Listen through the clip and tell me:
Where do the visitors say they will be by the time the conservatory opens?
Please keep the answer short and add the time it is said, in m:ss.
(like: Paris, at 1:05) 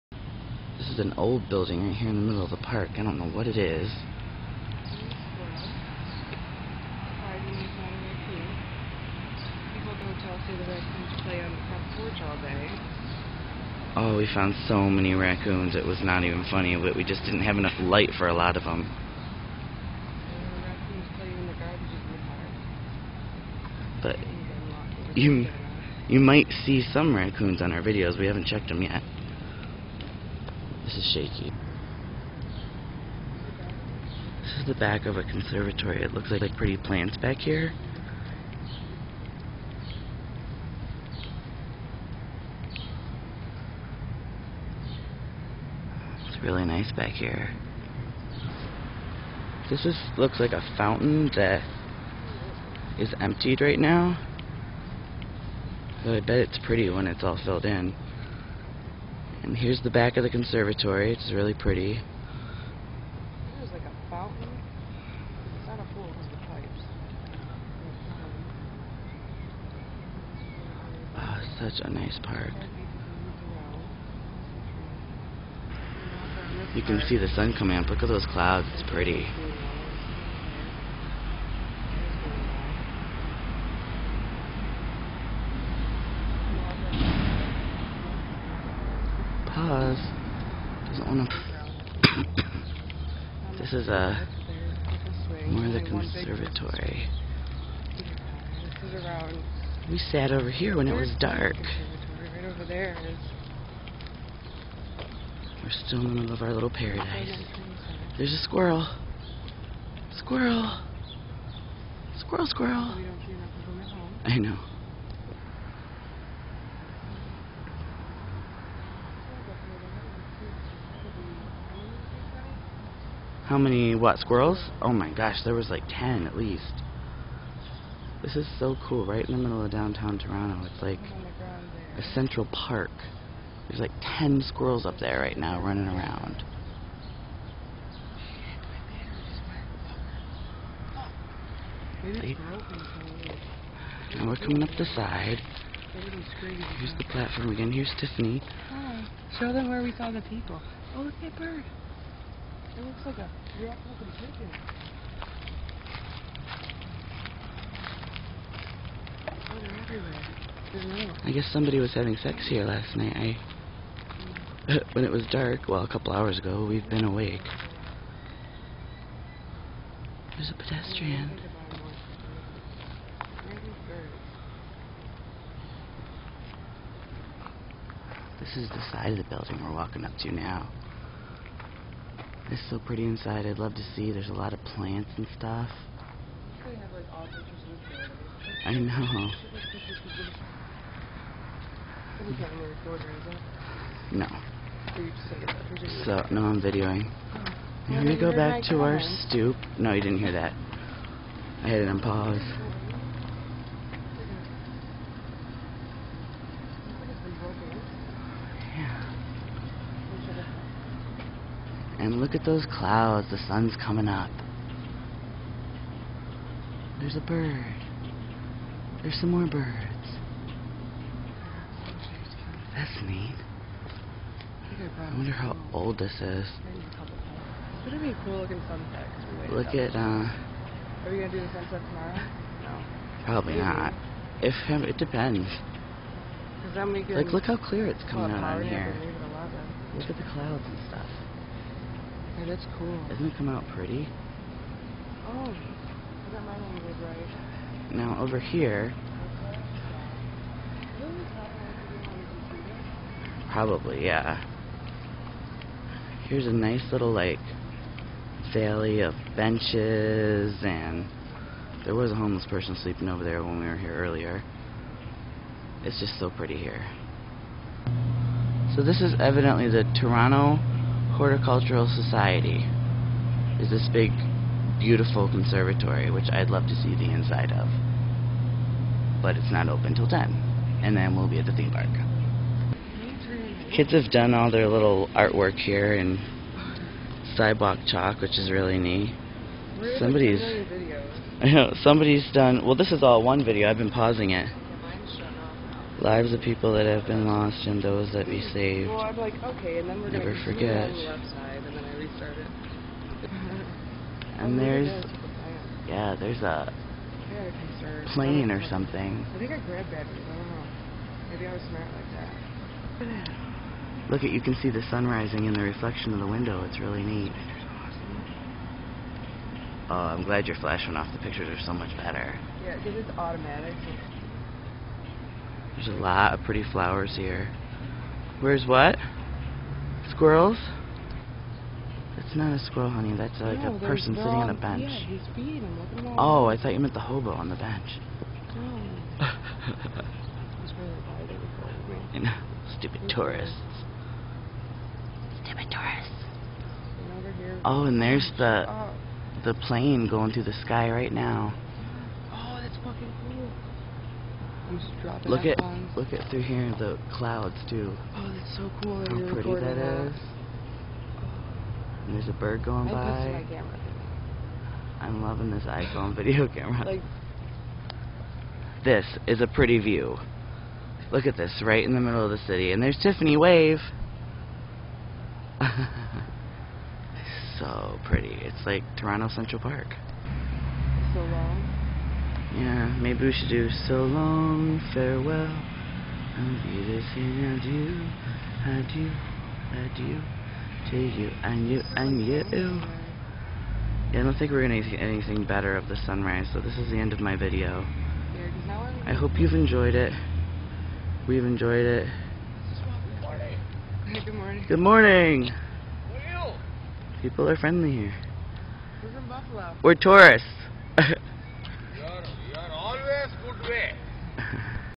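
the theme park, at 4:41.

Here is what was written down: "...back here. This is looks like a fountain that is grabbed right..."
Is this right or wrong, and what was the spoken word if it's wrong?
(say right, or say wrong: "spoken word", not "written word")
wrong: "emptied", not "grabbed".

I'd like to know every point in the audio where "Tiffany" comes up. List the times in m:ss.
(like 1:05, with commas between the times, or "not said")
2:27, 6:13.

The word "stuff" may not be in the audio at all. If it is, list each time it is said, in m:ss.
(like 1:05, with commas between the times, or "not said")
3:05, 4:00.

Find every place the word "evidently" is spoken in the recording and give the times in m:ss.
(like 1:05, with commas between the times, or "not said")
4:29.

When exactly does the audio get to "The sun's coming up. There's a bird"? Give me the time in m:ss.
3:33.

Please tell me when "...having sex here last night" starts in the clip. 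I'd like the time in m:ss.
2:41.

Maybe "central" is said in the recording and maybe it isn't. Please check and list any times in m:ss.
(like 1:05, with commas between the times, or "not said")
2:12, 6:19.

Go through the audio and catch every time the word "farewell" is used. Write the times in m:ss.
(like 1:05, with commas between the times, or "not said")
6:24.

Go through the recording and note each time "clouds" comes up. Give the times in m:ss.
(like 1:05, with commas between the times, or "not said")
1:18, 3:32, 4:00, 5:57.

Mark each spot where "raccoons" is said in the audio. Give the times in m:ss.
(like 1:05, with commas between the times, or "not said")
0:15, 0:27.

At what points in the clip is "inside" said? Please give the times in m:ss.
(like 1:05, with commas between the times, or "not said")
3:03, 4:37.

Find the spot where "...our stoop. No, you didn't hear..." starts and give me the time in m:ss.
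3:18.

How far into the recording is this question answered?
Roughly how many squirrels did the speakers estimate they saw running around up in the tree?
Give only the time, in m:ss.
2:05.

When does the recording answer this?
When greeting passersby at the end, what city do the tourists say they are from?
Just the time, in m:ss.
6:49.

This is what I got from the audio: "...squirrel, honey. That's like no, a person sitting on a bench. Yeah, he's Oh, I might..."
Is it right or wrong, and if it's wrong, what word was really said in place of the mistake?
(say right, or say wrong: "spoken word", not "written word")
wrong: "thought", not "might".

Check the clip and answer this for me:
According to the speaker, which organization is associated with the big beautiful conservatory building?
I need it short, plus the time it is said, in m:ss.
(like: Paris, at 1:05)
Toronto Horticultural Society, at 4:29.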